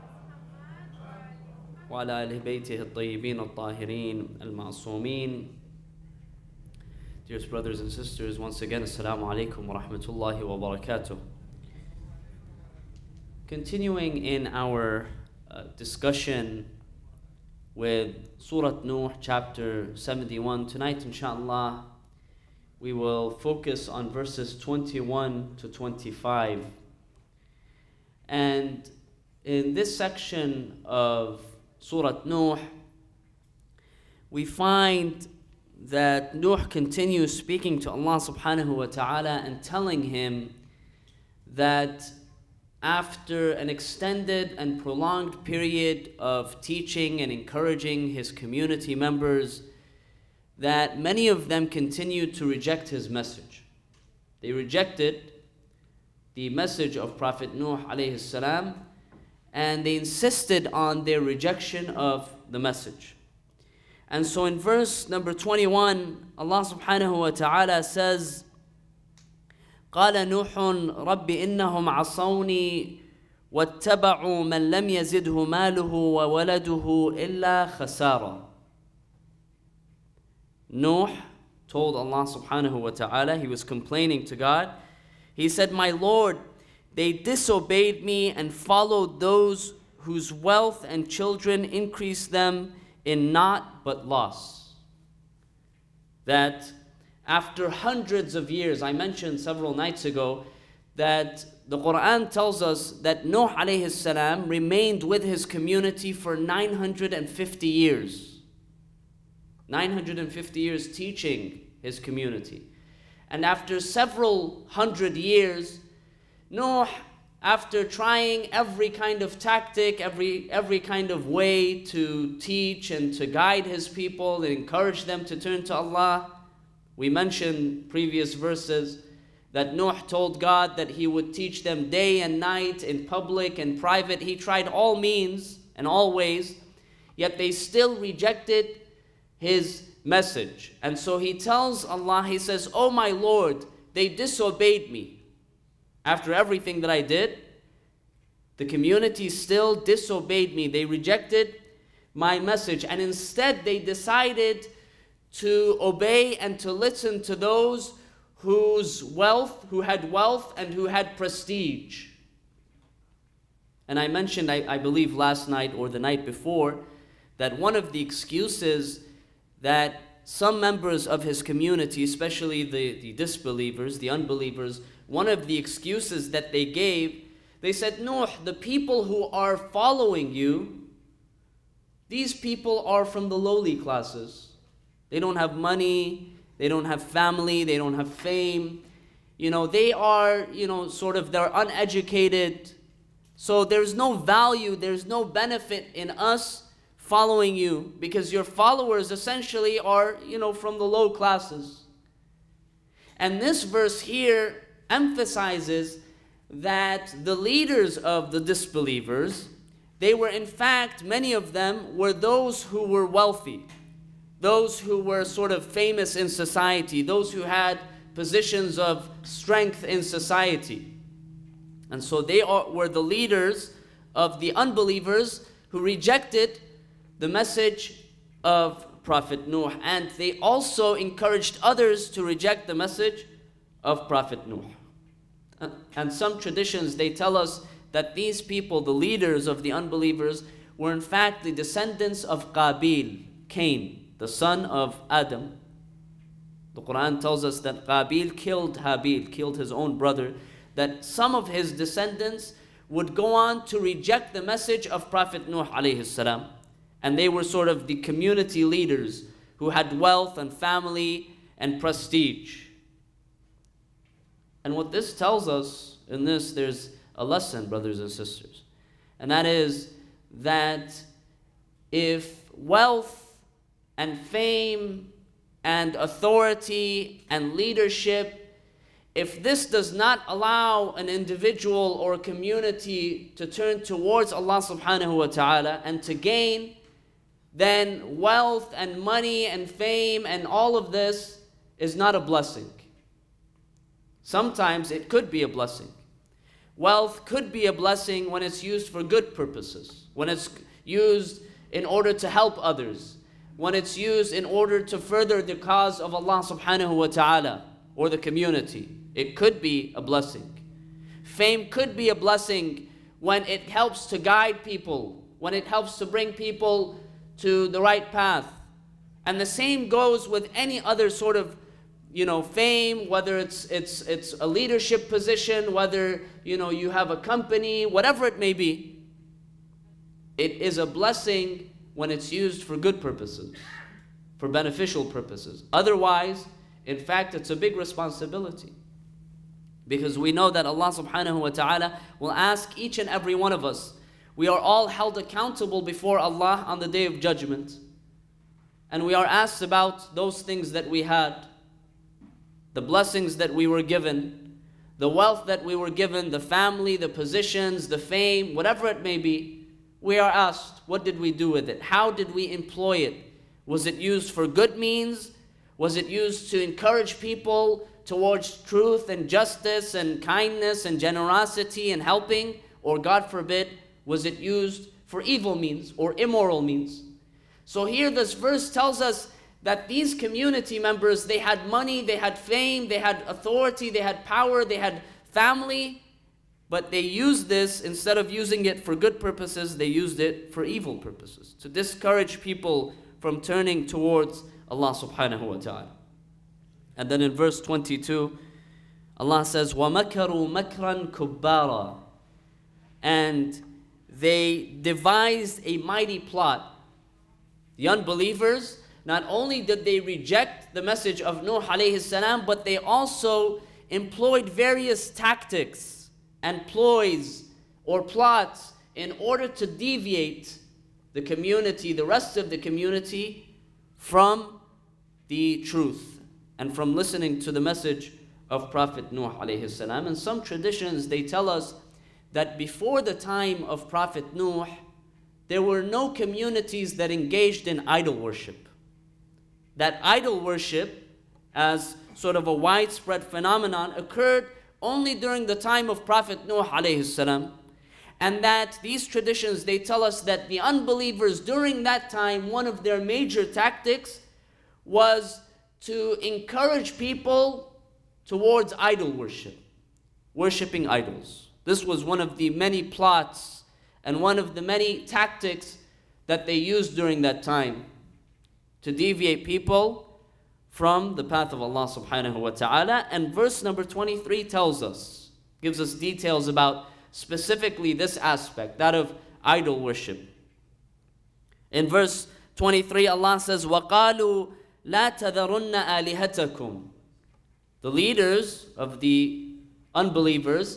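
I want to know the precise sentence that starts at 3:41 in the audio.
And so they are, were the leaders of the unbelievers who rejected the message of Prophet Nuh.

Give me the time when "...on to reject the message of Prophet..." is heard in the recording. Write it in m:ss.
4:13.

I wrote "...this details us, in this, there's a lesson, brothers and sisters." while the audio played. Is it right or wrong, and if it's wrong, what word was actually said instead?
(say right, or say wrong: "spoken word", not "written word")
wrong: "tells", not "details".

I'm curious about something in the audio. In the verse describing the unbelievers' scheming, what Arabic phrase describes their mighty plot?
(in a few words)
makran kubara.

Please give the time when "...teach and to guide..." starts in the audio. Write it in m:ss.
2:02.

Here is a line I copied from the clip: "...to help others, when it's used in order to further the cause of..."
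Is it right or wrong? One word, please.
right.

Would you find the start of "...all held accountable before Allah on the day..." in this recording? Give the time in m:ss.
5:44.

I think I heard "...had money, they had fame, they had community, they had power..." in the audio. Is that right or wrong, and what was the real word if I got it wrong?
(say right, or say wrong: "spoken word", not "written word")
wrong: "authority", not "community".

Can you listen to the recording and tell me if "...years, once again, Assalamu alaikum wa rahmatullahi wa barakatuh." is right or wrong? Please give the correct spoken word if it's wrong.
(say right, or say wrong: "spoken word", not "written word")
wrong: "sisters", not "years".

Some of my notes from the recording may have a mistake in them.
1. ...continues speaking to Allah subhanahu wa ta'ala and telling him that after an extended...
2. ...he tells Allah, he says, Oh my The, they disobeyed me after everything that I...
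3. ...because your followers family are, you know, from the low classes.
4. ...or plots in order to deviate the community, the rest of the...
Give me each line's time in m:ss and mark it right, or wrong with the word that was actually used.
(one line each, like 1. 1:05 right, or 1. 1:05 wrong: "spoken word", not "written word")
1. 0:36 right
2. 2:21 wrong: "Lord", not "The"
3. 3:17 wrong: "essentially", not "family"
4. 6:57 right.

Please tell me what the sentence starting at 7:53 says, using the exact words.
And verse number 23 tells us, gives us details about specifically this aspect, that of idol worship.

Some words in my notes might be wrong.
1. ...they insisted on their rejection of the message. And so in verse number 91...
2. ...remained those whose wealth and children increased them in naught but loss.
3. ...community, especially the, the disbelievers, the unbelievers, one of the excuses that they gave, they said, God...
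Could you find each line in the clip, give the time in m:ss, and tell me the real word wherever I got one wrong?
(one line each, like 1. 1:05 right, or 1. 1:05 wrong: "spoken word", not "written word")
1. 0:59 wrong: "21", not "91"
2. 1:28 wrong: "followed", not "remained"
3. 2:51 wrong: "Nuh", not "God".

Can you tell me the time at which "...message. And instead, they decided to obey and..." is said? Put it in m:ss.
2:32.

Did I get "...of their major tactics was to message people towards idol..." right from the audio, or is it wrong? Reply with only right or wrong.
wrong.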